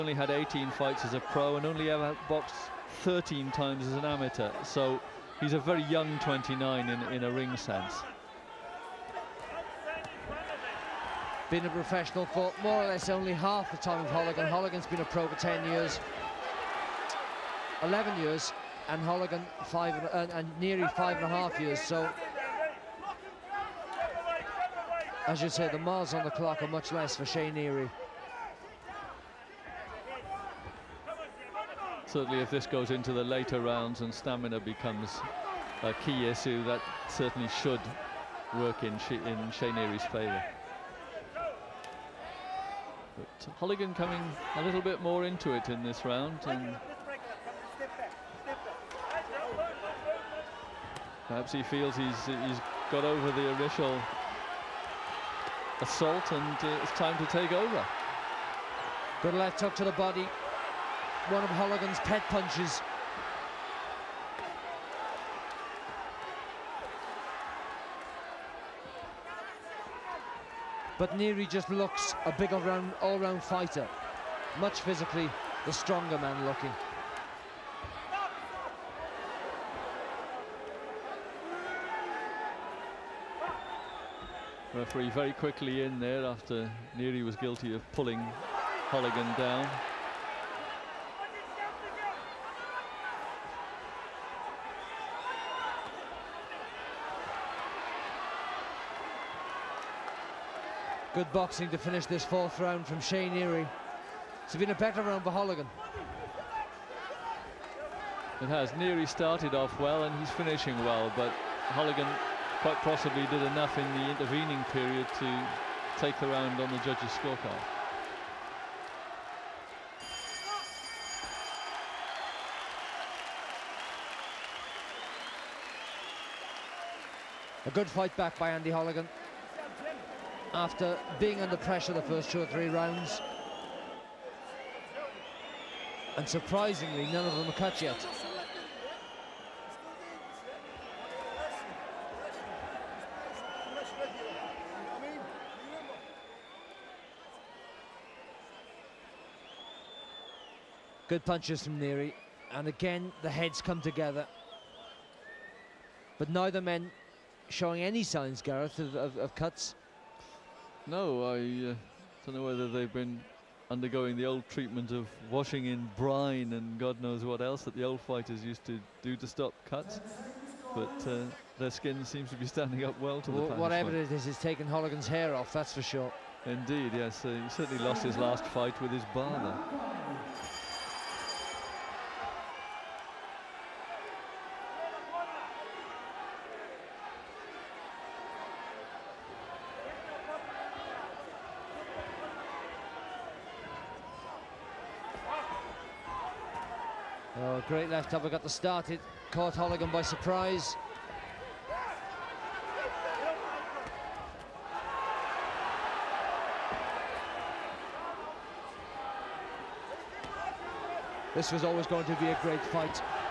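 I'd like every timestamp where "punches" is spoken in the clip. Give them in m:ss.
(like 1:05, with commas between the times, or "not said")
1:02, 2:31.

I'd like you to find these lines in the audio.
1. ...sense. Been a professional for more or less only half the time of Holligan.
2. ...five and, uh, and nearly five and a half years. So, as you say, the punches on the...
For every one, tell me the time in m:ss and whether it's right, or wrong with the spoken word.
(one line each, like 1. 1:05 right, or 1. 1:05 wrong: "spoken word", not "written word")
1. 0:07 right
2. 0:19 wrong: "miles", not "punches".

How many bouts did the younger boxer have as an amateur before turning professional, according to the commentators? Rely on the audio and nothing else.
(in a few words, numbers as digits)
13.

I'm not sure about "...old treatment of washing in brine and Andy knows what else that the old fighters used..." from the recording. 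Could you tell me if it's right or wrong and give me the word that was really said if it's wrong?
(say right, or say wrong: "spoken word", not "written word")
wrong: "God", not "Andy".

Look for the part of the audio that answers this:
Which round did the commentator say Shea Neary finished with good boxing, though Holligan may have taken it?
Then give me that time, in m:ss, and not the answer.
1:42.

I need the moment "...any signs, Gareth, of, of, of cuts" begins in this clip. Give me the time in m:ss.
2:37.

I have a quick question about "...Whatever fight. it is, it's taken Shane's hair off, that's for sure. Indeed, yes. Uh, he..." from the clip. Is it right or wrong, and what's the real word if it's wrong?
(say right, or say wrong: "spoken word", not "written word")
wrong: "Holligan", not "Shane".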